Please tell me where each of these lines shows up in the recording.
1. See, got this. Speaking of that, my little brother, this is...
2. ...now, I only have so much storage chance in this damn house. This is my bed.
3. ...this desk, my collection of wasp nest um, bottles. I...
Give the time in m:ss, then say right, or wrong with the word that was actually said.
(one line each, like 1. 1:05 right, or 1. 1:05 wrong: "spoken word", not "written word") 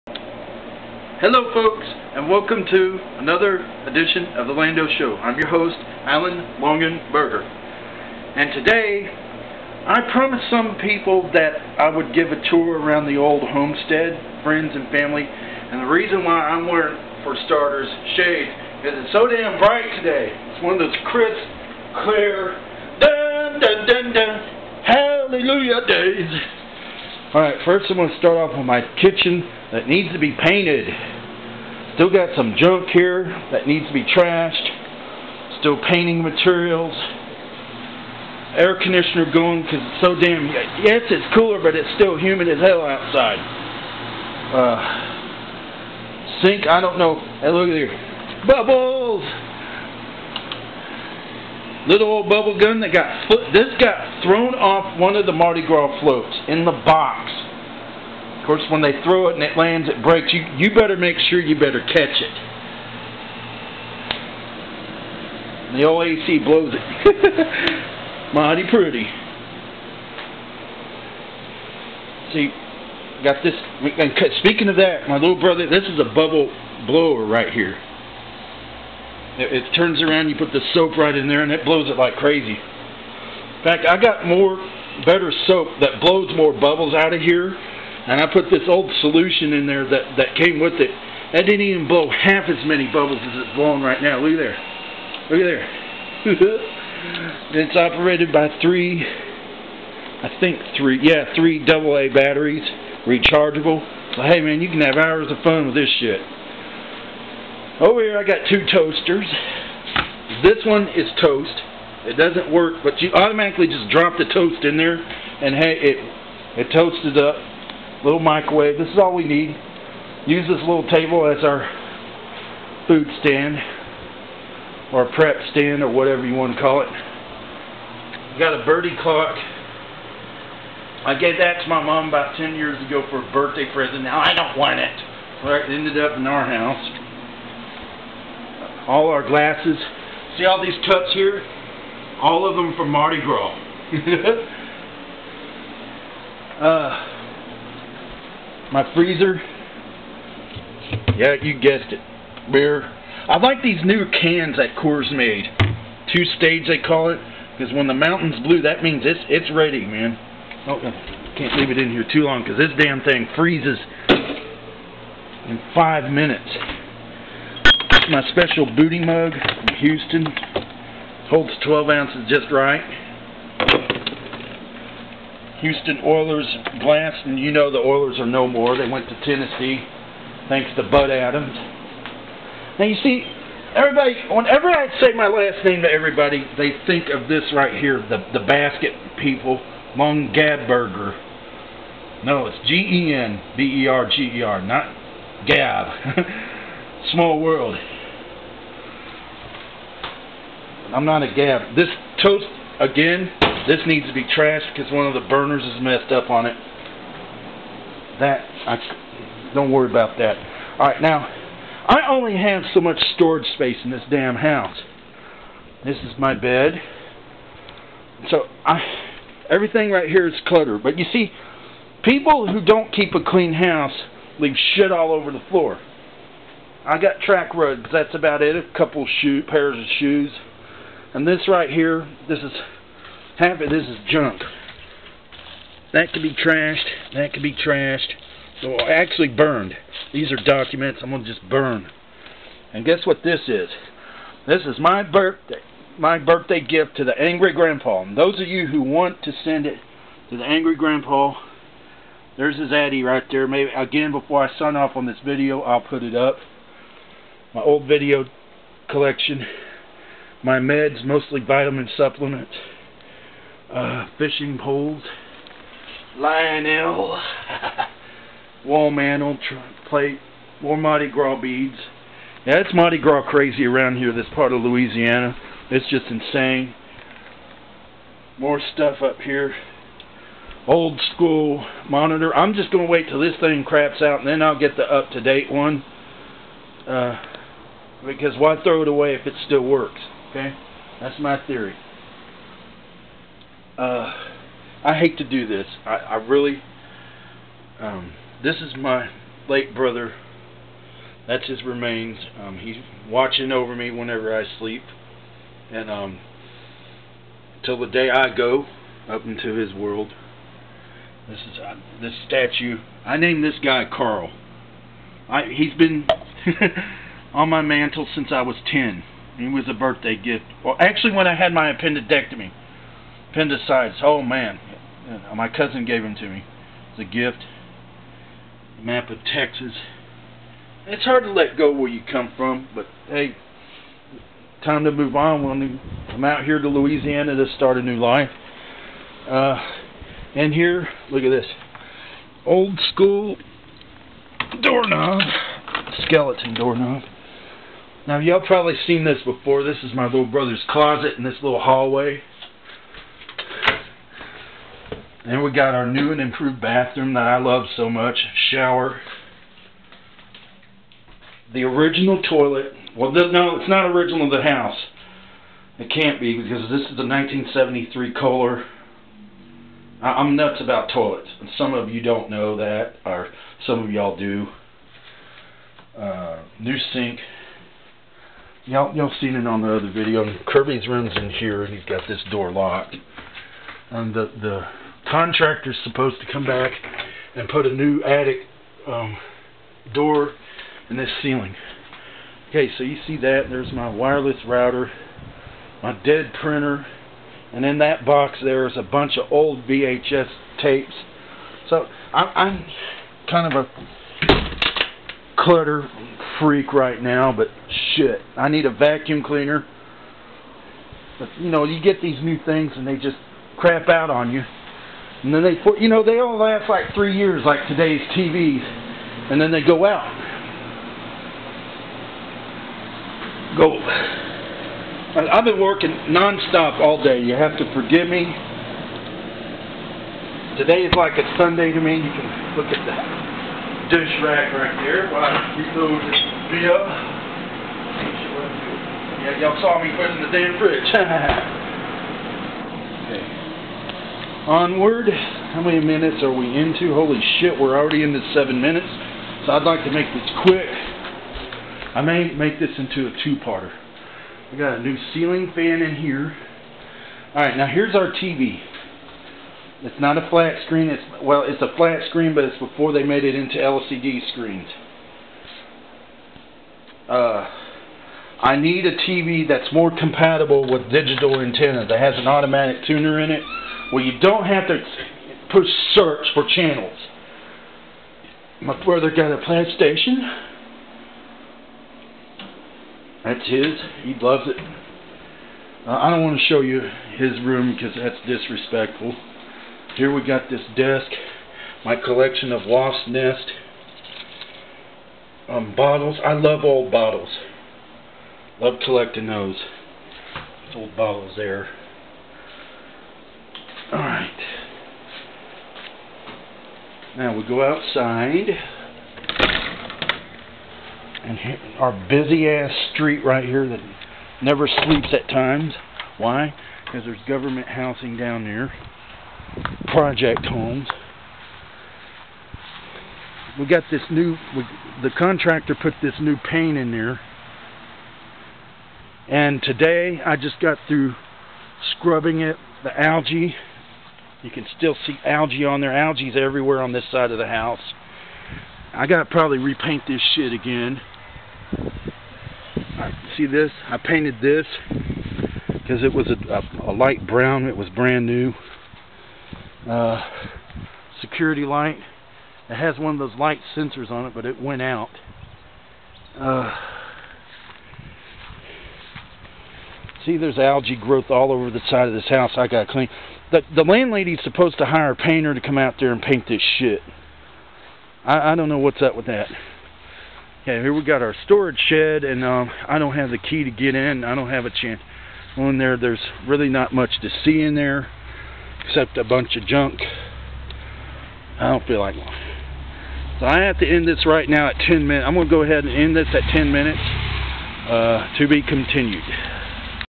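1. 1:12 right
2. 3:31 wrong: "space", not "chance"
3. 8:10 right.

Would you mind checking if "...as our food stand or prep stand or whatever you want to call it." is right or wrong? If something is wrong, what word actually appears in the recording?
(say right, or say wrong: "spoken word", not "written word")
right.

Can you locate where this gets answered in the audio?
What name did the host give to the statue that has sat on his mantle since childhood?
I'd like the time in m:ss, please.
5:13.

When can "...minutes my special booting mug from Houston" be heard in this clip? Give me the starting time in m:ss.
2:46.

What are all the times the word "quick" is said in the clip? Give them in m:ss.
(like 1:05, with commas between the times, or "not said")
7:30.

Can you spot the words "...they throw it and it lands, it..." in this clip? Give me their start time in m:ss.
0:58.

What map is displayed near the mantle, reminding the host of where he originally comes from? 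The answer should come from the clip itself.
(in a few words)
Map of Texas.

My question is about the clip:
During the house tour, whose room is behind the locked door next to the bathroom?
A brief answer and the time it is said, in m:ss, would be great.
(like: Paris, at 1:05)
Kirby, at 6:20.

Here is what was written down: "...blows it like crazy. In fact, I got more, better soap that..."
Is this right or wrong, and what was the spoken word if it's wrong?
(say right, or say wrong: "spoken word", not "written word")
right.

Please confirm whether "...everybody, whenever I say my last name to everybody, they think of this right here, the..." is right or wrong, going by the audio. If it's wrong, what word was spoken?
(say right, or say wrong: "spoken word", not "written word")
right.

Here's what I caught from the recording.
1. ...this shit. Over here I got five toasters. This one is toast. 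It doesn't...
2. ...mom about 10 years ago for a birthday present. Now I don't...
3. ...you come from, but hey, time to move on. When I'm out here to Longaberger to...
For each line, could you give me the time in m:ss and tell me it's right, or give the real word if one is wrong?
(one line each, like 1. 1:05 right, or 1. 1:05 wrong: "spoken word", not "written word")
1. 1:45 wrong: "two", not "five"
2. 2:11 right
3. 5:31 wrong: "Louisiana", not "Longaberger".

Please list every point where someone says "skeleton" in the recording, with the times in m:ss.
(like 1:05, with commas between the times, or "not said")
5:46.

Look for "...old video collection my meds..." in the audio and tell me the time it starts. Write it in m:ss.
4:17.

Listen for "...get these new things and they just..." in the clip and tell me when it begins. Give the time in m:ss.
6:51.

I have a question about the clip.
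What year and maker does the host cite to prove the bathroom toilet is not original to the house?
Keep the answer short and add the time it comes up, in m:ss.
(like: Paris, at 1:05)
1973 Kohler, at 6:07.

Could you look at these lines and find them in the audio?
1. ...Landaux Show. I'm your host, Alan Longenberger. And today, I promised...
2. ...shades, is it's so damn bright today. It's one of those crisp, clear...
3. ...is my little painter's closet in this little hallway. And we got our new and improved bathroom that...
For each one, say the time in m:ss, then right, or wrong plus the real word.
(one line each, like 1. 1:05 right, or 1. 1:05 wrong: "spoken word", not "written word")
1. 0:04 right
2. 0:18 right
3. 5:49 wrong: "brother", not "painter".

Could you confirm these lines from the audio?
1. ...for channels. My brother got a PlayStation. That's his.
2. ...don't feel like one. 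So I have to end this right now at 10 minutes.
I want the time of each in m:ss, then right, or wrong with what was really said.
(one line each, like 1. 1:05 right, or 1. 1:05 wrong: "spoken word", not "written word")
1. 7:56 right
2. 9:41 right.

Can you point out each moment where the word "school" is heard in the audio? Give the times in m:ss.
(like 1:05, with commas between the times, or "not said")
4:41, 5:42.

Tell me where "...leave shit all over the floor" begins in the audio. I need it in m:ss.
3:44.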